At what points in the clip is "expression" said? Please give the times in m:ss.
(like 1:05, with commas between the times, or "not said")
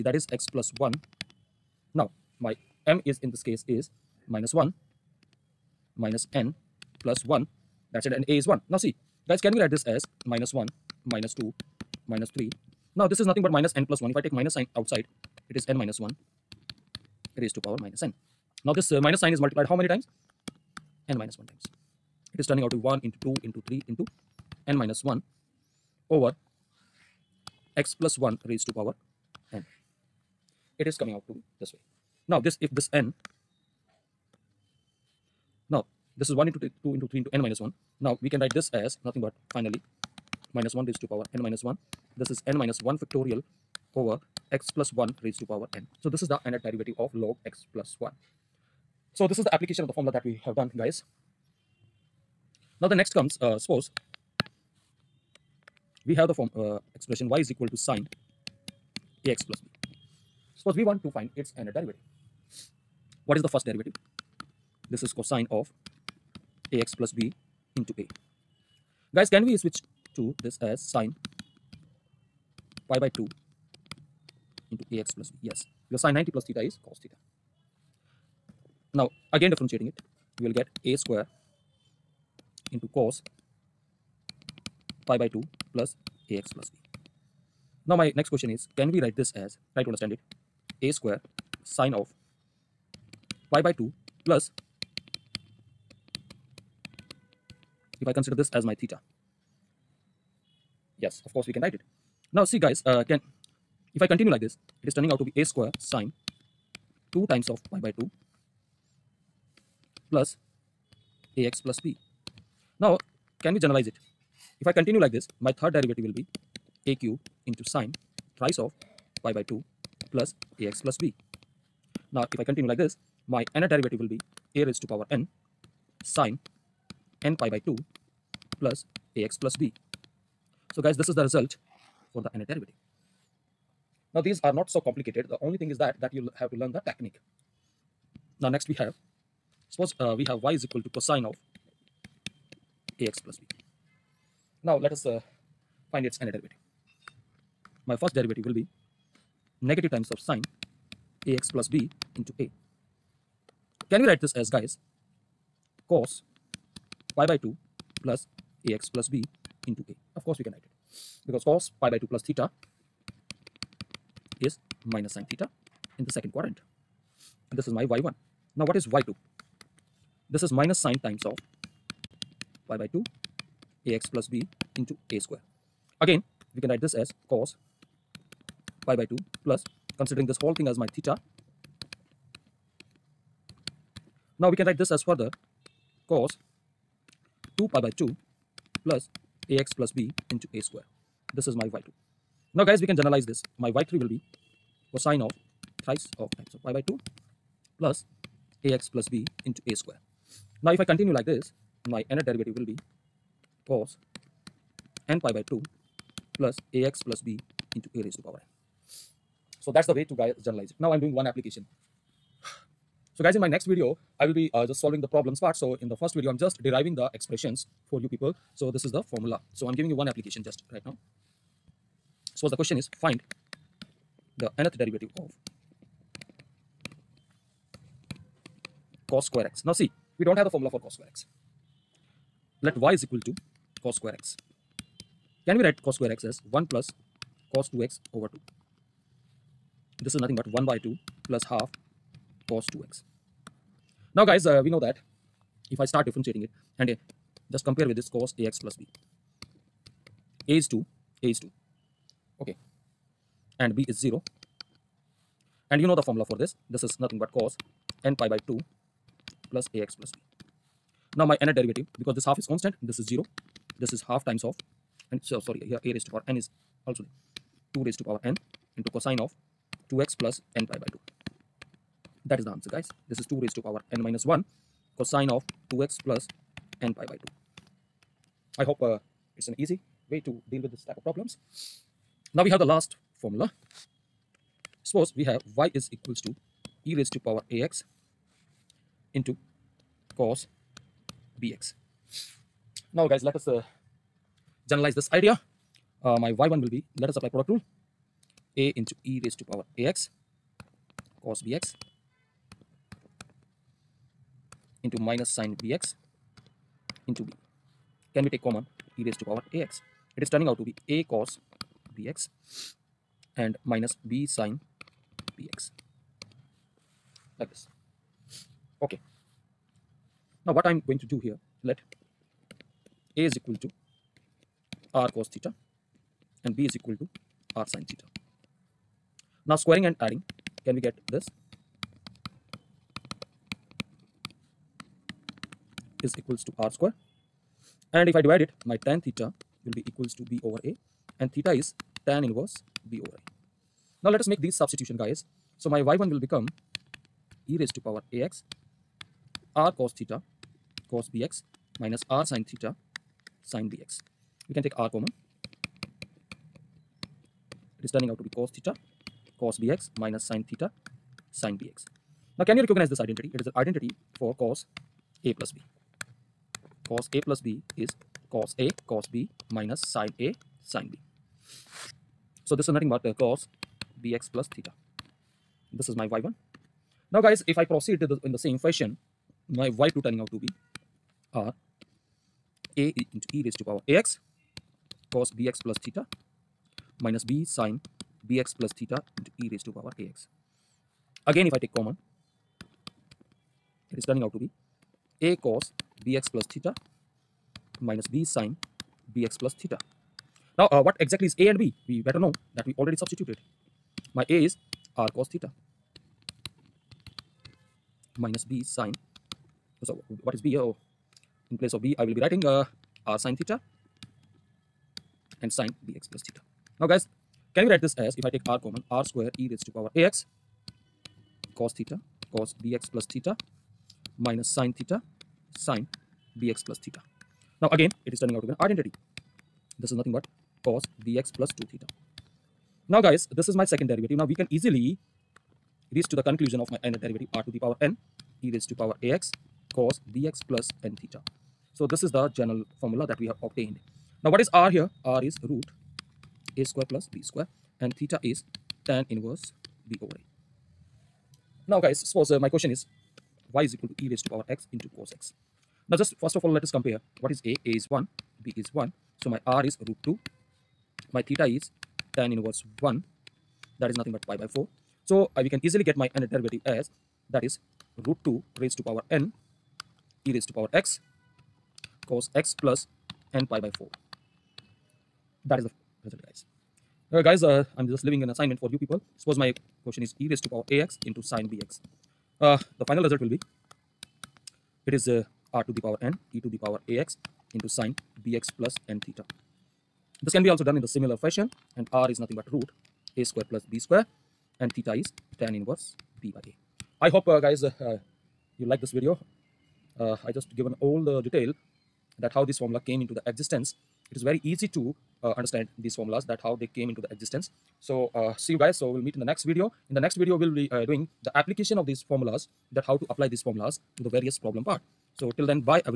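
0:56, 3:37.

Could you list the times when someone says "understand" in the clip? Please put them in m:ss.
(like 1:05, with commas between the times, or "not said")
1:29, 8:25.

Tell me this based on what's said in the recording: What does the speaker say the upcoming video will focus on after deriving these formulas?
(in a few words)
application of these formulas.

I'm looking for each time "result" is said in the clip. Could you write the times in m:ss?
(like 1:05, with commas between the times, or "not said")
2:11, 7:56, 8:03.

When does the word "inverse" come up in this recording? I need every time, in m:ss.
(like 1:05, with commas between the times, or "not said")
5:42, 7:29, 7:42, 8:15.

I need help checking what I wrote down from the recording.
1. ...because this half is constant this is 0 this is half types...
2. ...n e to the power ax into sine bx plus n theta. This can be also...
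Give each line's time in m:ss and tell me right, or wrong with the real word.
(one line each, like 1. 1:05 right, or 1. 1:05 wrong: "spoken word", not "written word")
1. 4:22 wrong: "times", not "types"
2. 8:06 right.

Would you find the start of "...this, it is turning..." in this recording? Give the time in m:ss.
1:44.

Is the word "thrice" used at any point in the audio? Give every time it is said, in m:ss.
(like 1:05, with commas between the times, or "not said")
1:58, 3:15.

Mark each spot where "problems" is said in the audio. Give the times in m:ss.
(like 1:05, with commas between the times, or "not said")
3:35, 4:41, 8:34.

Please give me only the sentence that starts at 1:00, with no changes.
Suppose we want to find its nth derivative.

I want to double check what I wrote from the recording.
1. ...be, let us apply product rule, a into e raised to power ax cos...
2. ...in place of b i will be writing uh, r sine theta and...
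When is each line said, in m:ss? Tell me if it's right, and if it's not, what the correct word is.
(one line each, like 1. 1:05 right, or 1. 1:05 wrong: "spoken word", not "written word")
1. 4:56 right
2. 6:51 right.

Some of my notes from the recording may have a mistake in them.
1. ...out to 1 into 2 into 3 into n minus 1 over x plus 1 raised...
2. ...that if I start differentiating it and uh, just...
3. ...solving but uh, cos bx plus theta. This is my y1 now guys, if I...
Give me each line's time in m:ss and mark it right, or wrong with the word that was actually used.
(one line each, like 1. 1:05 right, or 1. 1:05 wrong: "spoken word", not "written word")
1. 0:22 right
2. 4:04 right
3. 6:12 wrong: "nothing", not "solving".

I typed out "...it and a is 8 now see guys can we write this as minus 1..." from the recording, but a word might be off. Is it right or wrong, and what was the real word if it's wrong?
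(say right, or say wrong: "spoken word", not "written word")
wrong: "1", not "8".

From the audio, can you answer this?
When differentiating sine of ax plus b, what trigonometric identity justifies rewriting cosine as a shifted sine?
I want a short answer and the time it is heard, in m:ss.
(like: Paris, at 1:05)
sine 90 plus theta is cos theta, at 1:16.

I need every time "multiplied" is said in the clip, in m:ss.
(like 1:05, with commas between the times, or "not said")
0:19.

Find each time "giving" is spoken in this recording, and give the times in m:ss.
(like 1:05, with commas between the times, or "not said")
3:39.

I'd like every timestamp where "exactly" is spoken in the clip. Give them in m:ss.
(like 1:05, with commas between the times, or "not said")
6:41.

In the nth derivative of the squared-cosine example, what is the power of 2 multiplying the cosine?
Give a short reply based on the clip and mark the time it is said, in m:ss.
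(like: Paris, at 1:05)
n minus 1, at 4:33.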